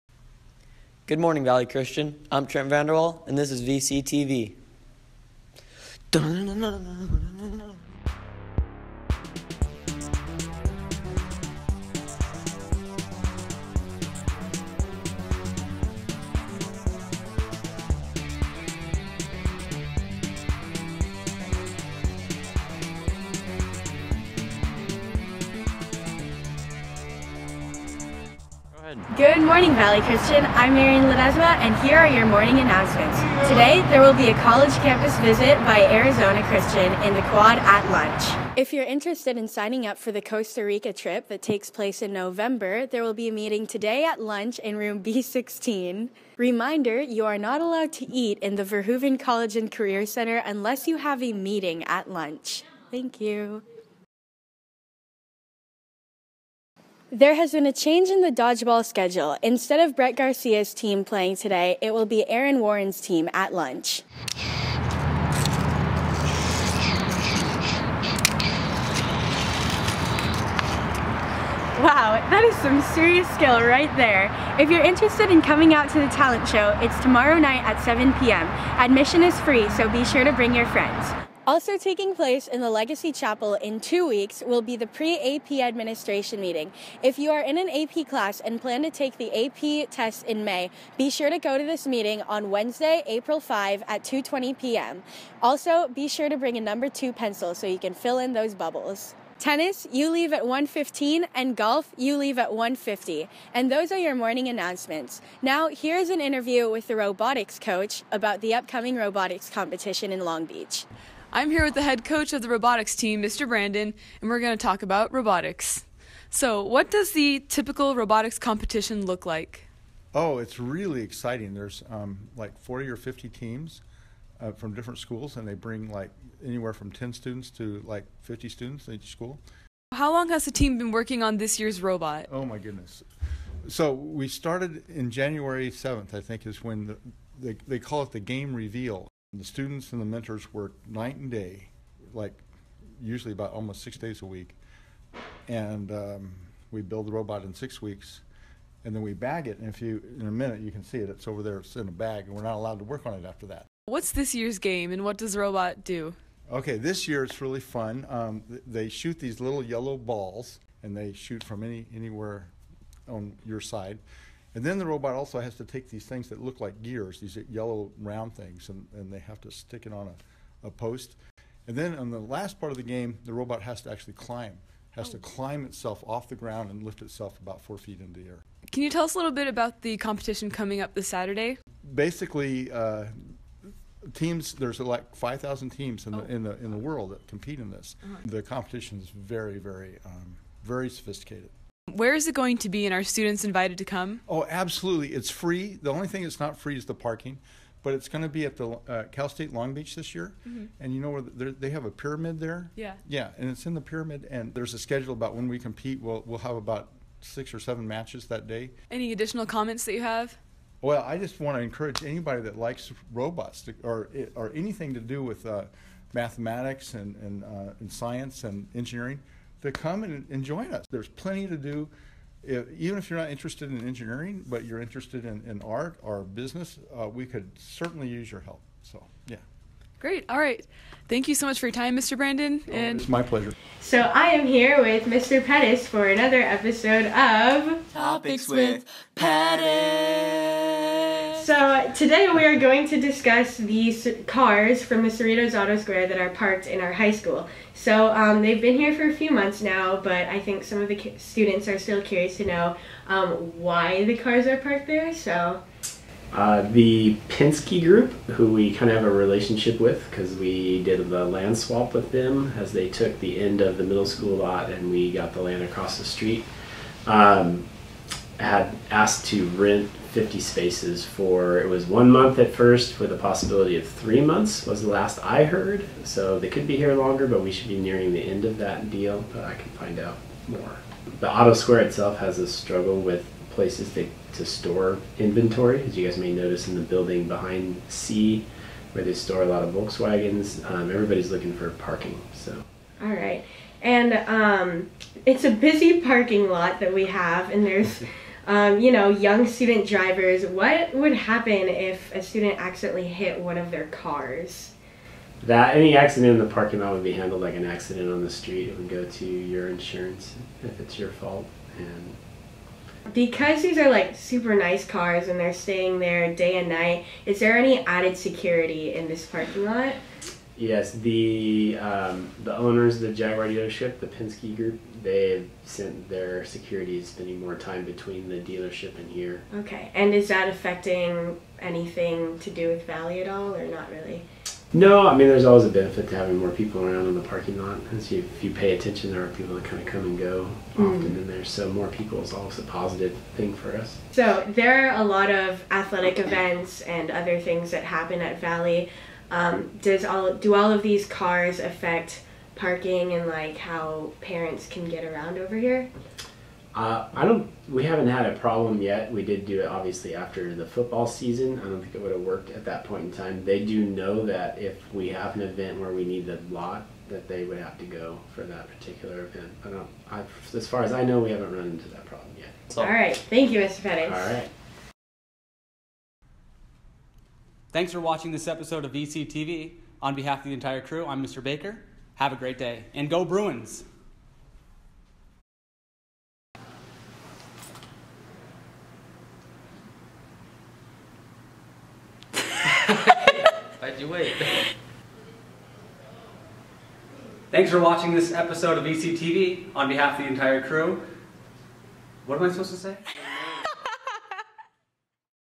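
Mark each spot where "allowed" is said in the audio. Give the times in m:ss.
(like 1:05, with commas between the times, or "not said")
0:47, 2:32.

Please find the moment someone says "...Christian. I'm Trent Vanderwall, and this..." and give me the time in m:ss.
0:01.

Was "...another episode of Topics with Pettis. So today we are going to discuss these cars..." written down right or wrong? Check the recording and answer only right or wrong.
right.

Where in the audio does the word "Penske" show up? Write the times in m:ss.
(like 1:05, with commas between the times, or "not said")
4:17, 5:24.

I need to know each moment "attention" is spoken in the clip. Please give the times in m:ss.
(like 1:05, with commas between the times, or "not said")
5:38.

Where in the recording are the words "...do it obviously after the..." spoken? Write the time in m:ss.
5:59.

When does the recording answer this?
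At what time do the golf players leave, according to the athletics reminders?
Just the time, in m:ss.
1:42.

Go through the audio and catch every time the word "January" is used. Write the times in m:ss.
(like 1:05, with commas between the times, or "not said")
2:15.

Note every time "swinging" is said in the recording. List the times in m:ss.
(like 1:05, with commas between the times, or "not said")
not said.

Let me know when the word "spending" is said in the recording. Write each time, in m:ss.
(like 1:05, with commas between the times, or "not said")
5:27.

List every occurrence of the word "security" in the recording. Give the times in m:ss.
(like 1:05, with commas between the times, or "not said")
5:18, 5:26.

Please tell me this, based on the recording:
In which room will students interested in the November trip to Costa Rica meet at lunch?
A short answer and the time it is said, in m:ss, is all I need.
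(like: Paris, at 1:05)
B16, at 0:45.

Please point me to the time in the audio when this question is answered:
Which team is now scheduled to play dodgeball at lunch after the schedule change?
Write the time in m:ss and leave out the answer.
1:02.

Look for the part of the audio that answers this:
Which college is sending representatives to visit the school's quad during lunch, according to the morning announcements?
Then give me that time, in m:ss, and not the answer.
0:35.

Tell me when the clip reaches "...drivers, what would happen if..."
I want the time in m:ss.
4:59.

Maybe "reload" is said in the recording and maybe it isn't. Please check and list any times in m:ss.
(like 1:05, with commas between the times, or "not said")
not said.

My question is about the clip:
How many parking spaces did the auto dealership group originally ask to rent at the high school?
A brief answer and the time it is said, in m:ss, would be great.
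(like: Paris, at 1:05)
50, at 4:30.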